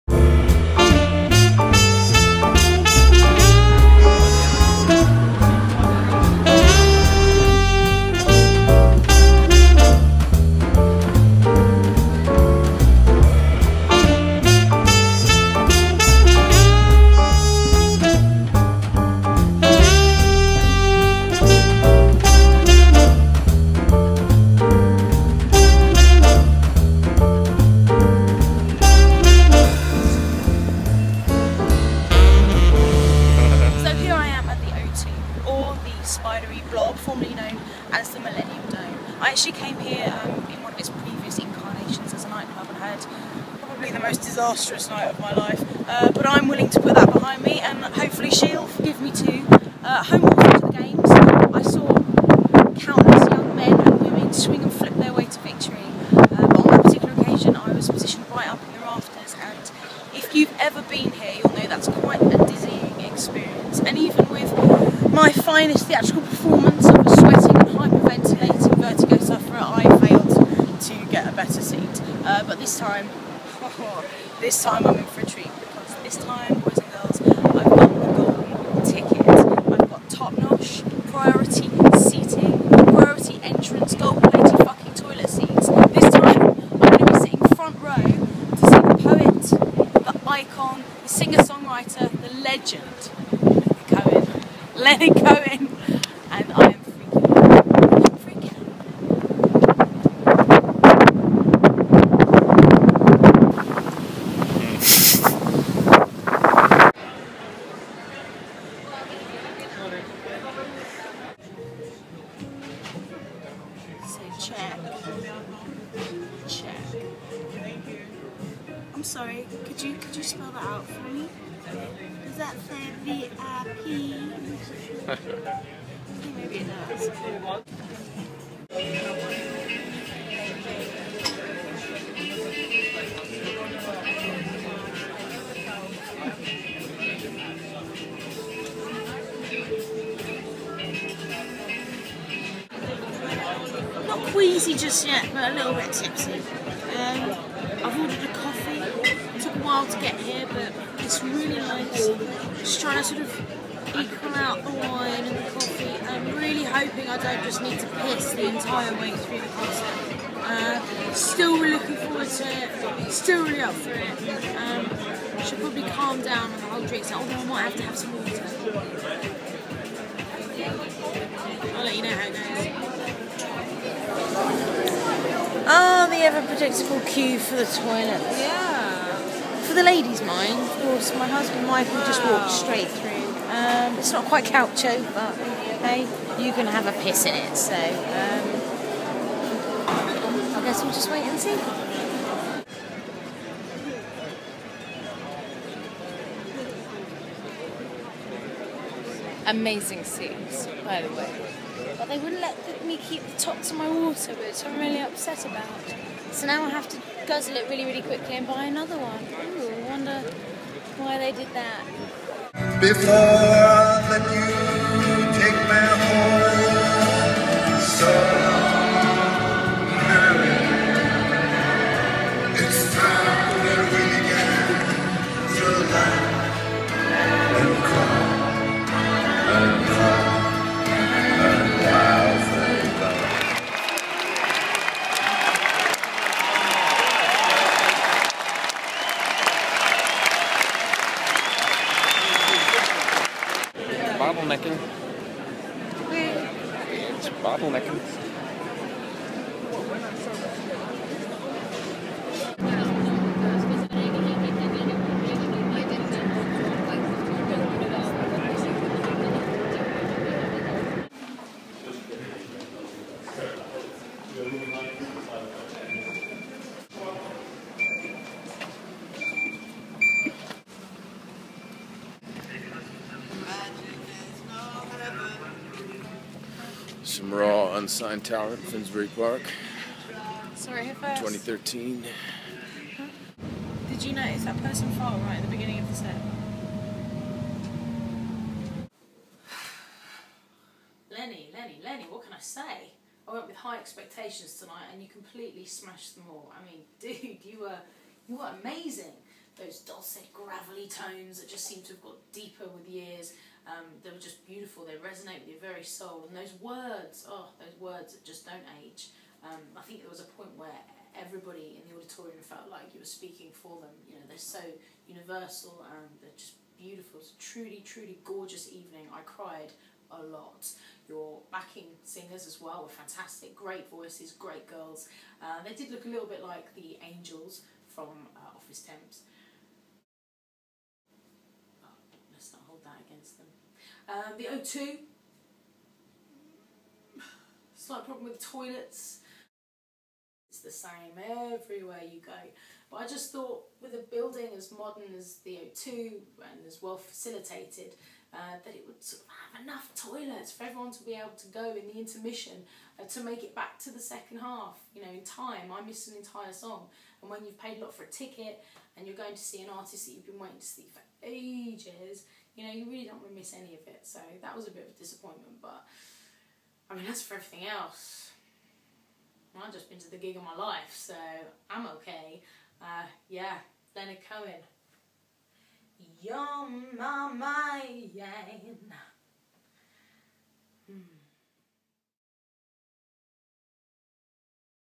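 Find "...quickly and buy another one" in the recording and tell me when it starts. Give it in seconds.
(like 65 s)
208 s.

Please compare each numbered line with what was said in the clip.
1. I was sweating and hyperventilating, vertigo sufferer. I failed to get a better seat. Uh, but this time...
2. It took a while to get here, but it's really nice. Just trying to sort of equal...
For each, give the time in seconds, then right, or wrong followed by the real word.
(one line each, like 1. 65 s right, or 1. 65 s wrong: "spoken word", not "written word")
1. 66 s right
2. 148 s right.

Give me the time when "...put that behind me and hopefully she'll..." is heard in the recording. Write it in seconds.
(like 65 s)
46 s.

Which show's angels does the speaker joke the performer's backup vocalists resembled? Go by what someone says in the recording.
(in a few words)
Office Temps.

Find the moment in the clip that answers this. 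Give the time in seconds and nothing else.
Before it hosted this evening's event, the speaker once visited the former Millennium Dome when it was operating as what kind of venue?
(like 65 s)
42 s.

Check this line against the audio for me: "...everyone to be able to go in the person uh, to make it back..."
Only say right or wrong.
wrong.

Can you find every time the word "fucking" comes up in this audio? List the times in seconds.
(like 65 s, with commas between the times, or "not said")
84 s.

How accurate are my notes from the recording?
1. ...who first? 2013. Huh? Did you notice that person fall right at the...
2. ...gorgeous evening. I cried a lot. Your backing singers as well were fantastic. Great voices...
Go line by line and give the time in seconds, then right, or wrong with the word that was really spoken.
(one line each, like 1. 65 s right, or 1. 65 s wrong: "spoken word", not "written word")
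1. 280 s right
2. 318 s right.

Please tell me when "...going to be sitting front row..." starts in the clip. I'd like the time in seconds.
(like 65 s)
86 s.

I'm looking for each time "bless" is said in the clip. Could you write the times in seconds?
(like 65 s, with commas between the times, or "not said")
not said.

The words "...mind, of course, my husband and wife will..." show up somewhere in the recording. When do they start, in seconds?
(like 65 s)
180 s.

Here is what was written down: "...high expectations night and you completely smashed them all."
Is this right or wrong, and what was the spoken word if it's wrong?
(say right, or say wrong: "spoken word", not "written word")
wrong: "tonight", not "night".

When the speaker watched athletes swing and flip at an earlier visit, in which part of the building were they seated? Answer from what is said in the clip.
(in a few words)
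the rafters.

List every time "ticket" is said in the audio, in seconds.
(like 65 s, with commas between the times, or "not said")
78 s, 358 s.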